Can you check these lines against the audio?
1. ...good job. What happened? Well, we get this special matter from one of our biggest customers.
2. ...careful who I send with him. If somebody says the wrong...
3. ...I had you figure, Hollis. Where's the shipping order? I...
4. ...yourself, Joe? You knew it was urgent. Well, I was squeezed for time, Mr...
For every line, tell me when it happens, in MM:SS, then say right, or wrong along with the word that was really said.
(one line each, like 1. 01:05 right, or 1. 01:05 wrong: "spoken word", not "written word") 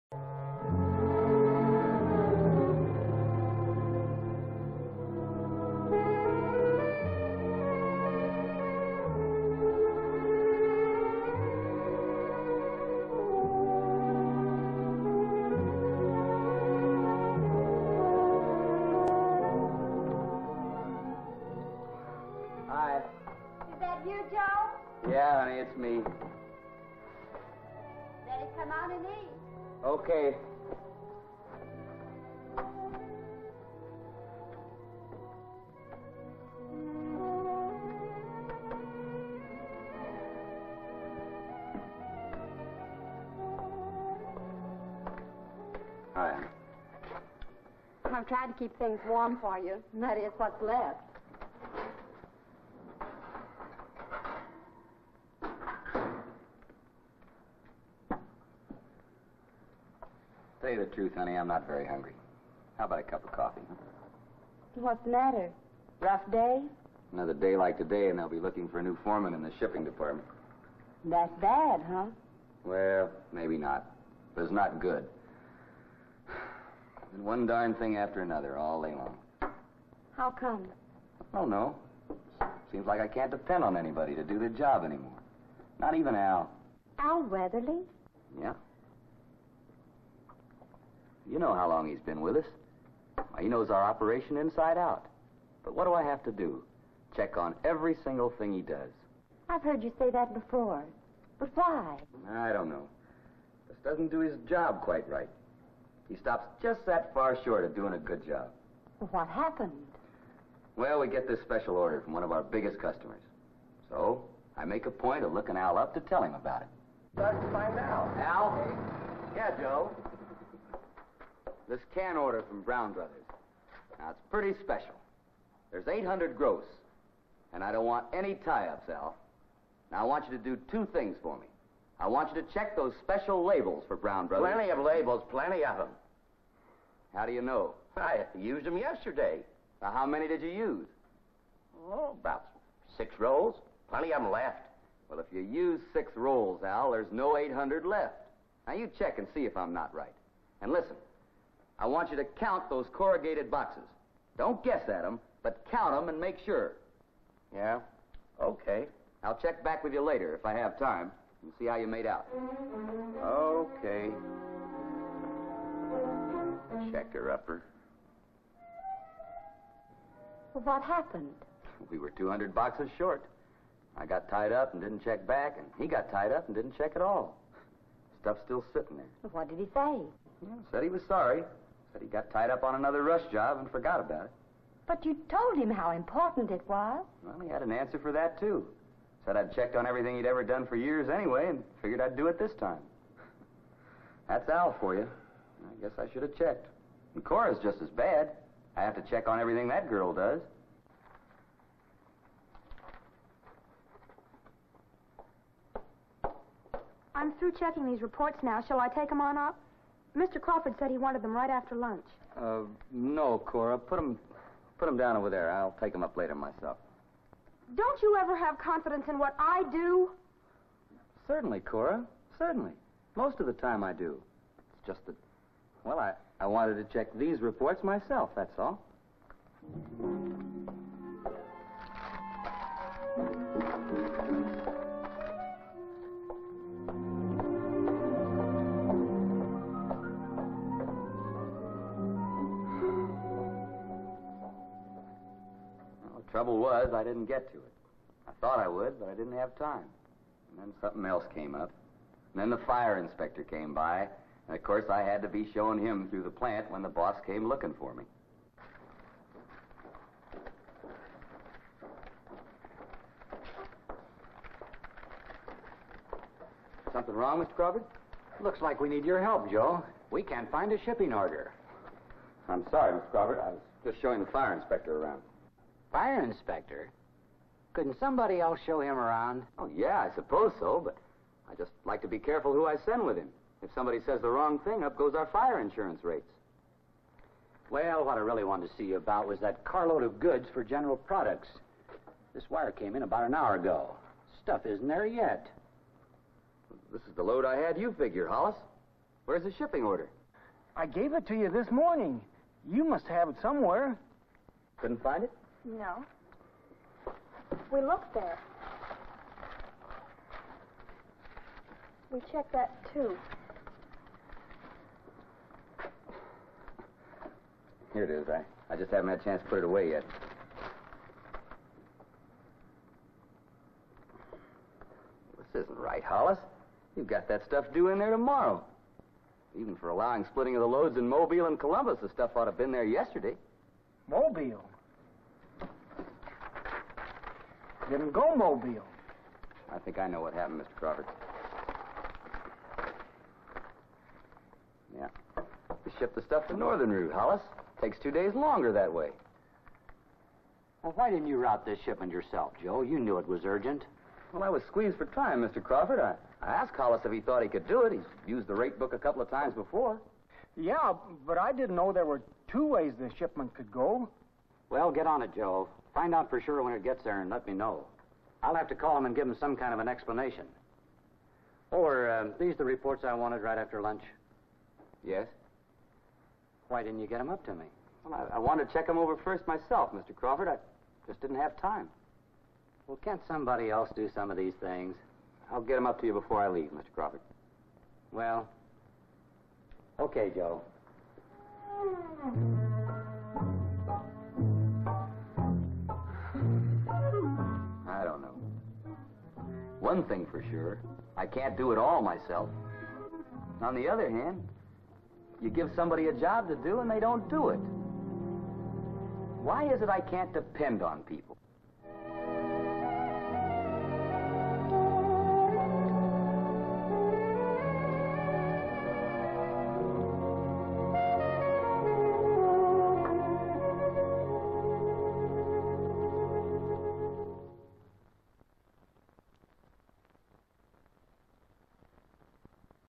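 1. 01:47 wrong: "order", not "matter"
2. 04:42 right
3. 04:57 right
4. 05:52 right.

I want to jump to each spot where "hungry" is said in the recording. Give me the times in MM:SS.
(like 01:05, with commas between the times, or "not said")
01:01.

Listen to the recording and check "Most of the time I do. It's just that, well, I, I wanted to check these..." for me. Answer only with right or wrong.
right.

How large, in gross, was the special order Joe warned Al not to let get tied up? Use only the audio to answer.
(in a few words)
800.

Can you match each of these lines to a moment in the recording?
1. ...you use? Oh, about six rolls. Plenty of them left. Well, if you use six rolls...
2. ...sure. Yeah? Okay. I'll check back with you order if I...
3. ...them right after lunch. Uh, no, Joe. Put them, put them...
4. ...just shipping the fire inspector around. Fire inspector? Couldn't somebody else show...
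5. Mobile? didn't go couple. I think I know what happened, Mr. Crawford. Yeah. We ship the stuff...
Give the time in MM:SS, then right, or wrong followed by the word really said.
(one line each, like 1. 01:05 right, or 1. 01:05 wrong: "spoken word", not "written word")
1. 02:20 right
2. 02:36 wrong: "later", not "order"
3. 03:31 wrong: "Cora", not "Joe"
4. 04:33 wrong: "showing", not "shipping"
5. 05:34 wrong: "mobile", not "couple".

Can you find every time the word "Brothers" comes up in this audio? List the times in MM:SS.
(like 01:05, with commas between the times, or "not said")
02:02, 02:14.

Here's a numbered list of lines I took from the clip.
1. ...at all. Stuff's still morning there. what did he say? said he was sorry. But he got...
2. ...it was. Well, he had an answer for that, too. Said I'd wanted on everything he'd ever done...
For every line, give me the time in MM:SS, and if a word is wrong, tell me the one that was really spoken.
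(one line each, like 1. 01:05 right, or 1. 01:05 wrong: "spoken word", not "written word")
1. 02:56 wrong: "sitting", not "morning"
2. 03:06 wrong: "checked", not "wanted".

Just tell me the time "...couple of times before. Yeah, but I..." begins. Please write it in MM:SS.
05:58.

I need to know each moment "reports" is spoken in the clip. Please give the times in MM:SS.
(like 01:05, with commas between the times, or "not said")
03:28, 03:47, 06:12.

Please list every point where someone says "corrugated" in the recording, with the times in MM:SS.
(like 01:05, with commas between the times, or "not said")
02:32.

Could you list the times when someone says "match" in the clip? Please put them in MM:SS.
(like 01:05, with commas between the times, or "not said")
not said.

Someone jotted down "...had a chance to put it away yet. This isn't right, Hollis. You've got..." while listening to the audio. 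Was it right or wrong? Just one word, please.
right.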